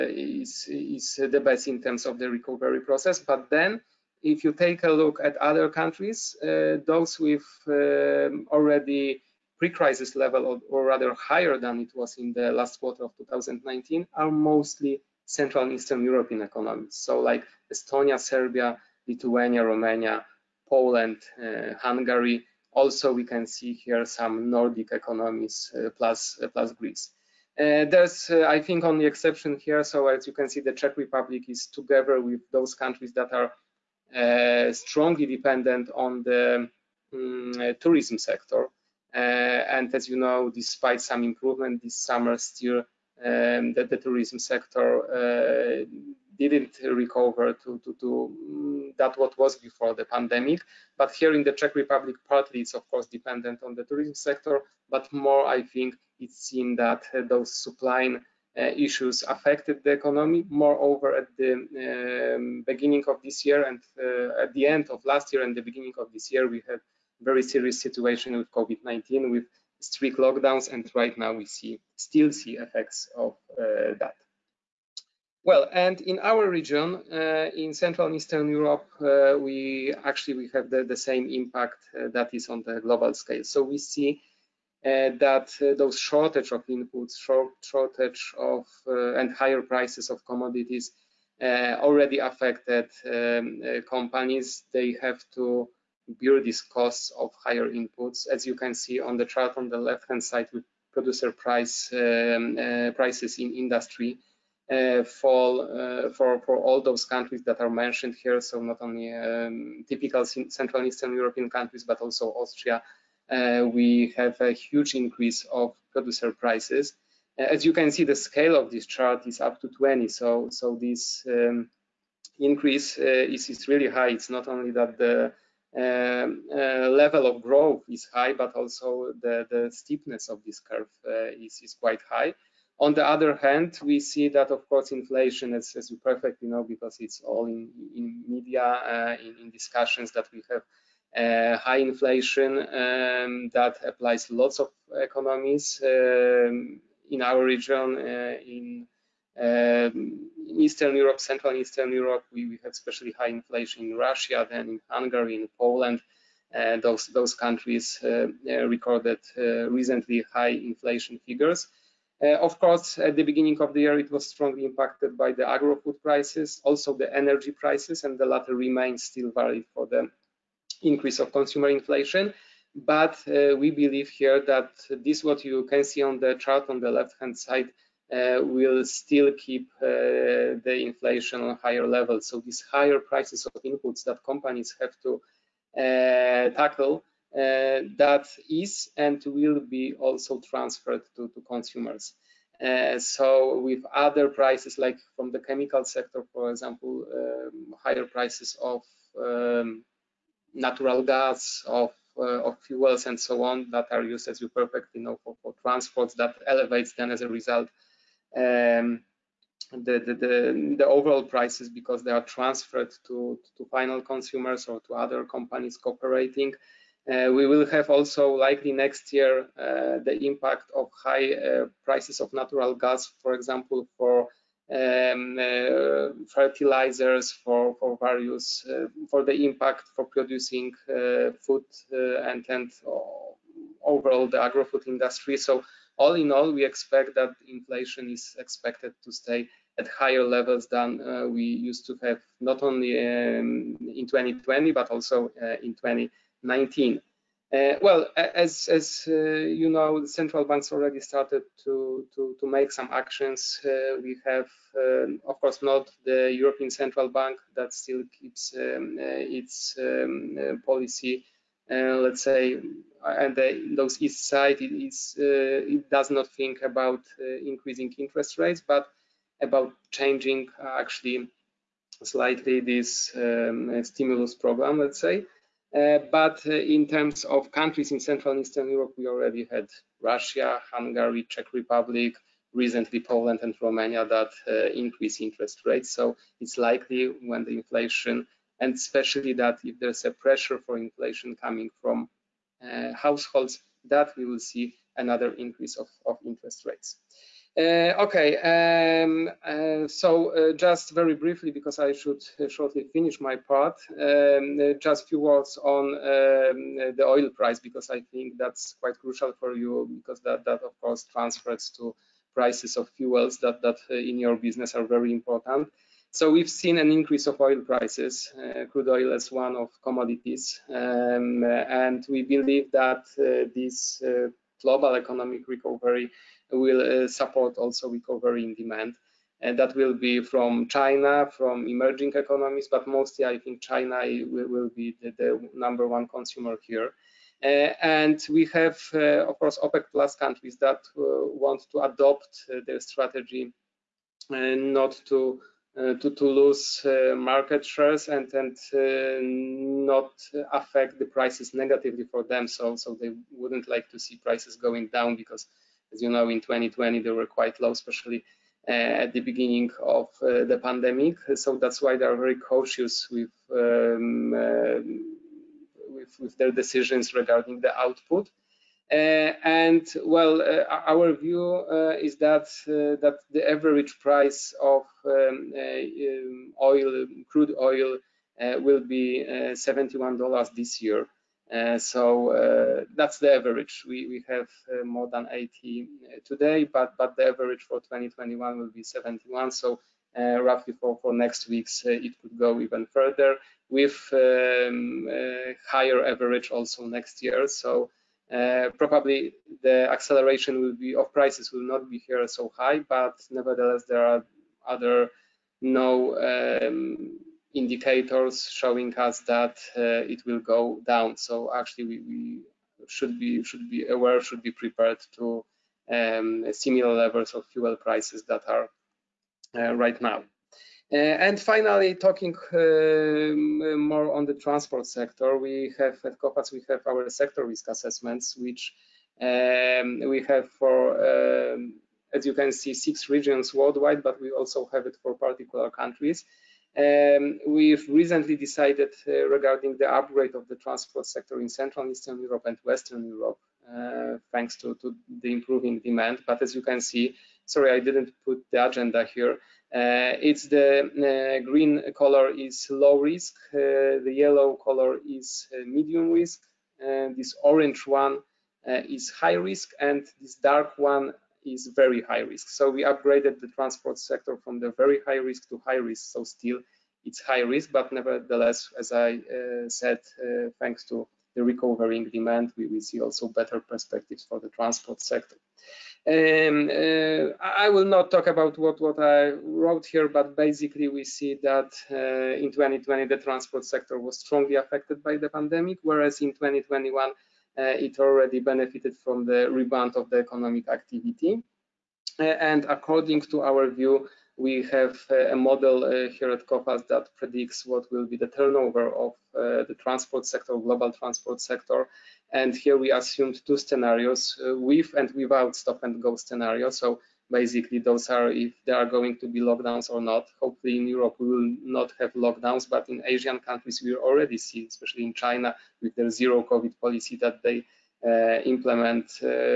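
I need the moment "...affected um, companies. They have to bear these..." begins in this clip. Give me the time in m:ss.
1:32.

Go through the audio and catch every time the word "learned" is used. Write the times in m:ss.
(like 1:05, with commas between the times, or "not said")
not said.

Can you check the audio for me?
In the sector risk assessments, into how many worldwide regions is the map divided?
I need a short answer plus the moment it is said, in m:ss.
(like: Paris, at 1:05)
6, at 7:12.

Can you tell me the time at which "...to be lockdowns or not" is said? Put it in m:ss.
8:29.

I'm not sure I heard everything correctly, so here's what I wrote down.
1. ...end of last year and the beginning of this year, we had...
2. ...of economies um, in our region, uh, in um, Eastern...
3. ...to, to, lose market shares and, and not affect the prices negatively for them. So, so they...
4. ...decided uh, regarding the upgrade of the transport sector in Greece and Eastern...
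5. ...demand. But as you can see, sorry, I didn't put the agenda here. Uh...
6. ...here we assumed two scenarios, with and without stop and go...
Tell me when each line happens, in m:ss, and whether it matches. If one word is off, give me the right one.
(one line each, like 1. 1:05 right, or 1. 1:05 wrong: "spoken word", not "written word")
1. 1:04 right
2. 2:24 right
3. 5:45 right
4. 7:18 wrong: "Central", not "Greece"
5. 7:25 right
6. 8:22 right.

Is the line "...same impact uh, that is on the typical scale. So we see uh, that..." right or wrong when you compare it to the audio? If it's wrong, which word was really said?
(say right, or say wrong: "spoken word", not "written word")
wrong: "global", not "typical".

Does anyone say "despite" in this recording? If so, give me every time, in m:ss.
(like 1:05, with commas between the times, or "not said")
0:40.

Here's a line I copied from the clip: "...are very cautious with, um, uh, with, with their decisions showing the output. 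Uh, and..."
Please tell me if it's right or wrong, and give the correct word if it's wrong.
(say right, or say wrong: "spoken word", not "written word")
wrong: "regarding", not "showing".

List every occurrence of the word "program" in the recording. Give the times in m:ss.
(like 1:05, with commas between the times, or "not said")
4:34.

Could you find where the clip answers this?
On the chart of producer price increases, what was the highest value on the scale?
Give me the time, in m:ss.
1:59.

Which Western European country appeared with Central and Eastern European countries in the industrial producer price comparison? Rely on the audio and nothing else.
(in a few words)
Austria.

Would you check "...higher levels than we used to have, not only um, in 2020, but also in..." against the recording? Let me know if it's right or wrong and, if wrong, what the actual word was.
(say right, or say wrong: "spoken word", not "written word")
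right.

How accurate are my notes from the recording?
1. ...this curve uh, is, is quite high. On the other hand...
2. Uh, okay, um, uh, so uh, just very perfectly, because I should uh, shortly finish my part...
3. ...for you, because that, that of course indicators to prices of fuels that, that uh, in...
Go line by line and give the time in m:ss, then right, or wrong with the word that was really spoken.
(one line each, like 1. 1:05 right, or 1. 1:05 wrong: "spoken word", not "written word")
1. 2:10 right
2. 4:57 wrong: "briefly", not "perfectly"
3. 5:09 wrong: "transfers", not "indicators".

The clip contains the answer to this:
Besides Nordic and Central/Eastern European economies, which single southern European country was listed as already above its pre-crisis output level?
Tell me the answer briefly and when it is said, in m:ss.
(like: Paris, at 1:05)
Greece, at 0:26.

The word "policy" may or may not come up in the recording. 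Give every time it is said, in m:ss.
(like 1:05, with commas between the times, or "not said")
4:20, 8:36.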